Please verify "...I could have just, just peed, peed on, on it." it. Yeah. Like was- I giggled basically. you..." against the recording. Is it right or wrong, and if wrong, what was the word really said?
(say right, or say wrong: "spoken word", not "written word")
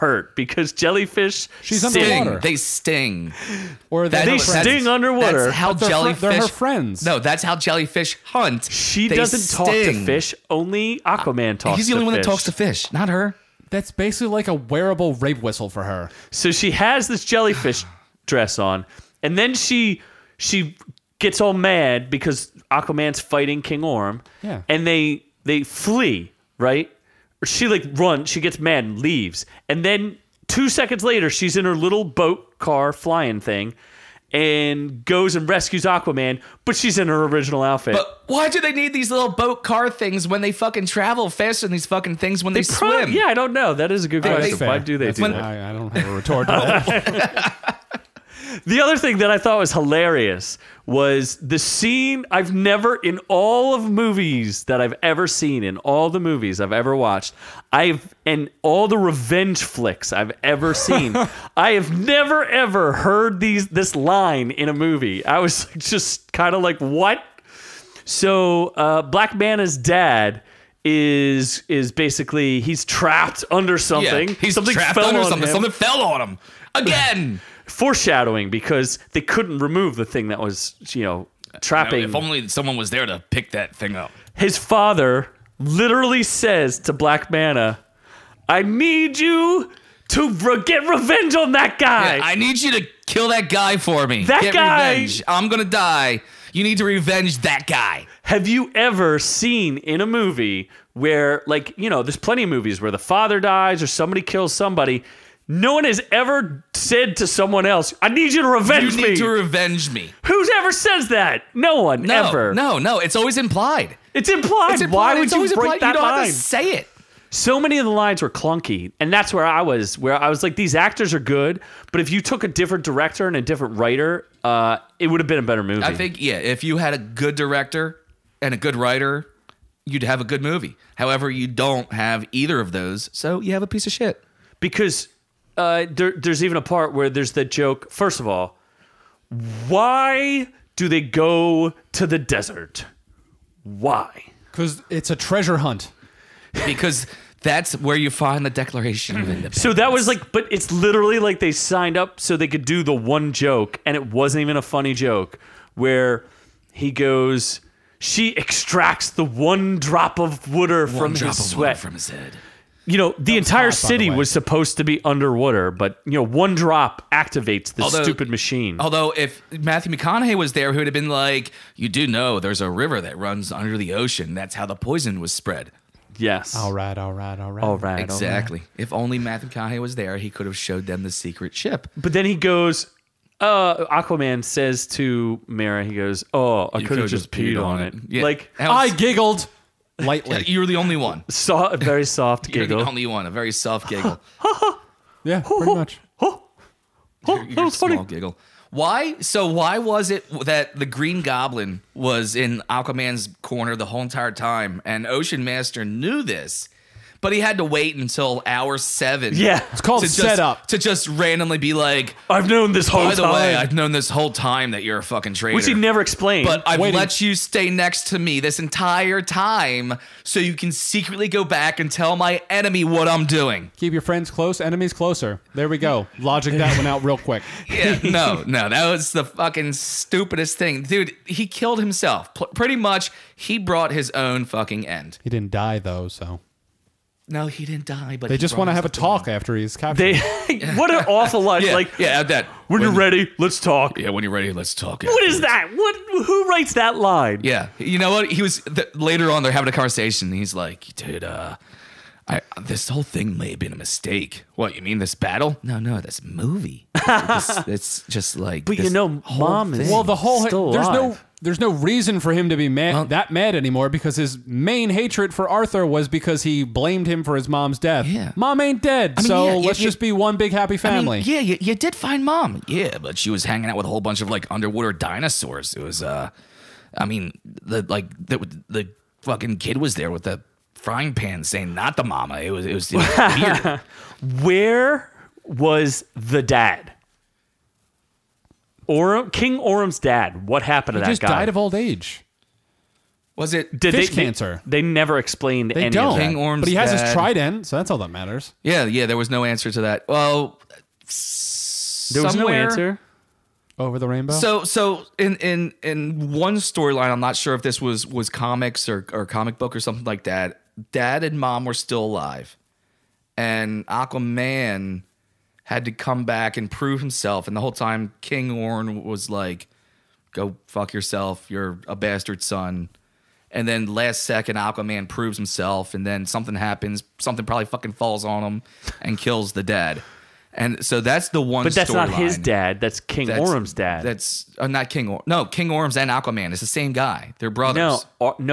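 wrong: "lightly", not "basically".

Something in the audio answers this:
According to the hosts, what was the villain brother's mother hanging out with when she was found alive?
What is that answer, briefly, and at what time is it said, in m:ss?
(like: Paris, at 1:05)
Underwater dinosaurs, at 4:34.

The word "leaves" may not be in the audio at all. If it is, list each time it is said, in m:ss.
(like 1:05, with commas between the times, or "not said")
0:28.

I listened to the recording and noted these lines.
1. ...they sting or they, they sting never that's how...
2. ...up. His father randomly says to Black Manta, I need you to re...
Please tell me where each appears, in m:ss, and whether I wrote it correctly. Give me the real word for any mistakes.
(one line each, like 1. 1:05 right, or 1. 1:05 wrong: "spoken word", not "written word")
1. 0:02 wrong: "underwater", not "never"
2. 1:23 wrong: "literally", not "randomly".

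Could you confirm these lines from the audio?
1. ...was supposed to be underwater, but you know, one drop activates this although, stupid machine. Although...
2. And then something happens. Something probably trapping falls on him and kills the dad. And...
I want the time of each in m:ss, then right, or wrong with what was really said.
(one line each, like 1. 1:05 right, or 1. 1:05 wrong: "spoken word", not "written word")
1. 2:44 right
2. 5:25 wrong: "fucking", not "trapping".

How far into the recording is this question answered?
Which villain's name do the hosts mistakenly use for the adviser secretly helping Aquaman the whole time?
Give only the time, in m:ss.
3:20.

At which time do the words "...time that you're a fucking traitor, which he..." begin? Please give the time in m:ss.
3:34.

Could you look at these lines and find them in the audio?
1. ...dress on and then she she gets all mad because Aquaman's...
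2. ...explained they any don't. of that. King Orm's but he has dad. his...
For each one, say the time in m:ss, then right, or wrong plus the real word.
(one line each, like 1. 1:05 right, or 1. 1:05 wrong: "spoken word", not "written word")
1. 0:18 right
2. 4:55 right.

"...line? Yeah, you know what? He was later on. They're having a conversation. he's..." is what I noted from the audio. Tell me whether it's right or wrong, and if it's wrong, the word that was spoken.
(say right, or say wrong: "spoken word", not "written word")
right.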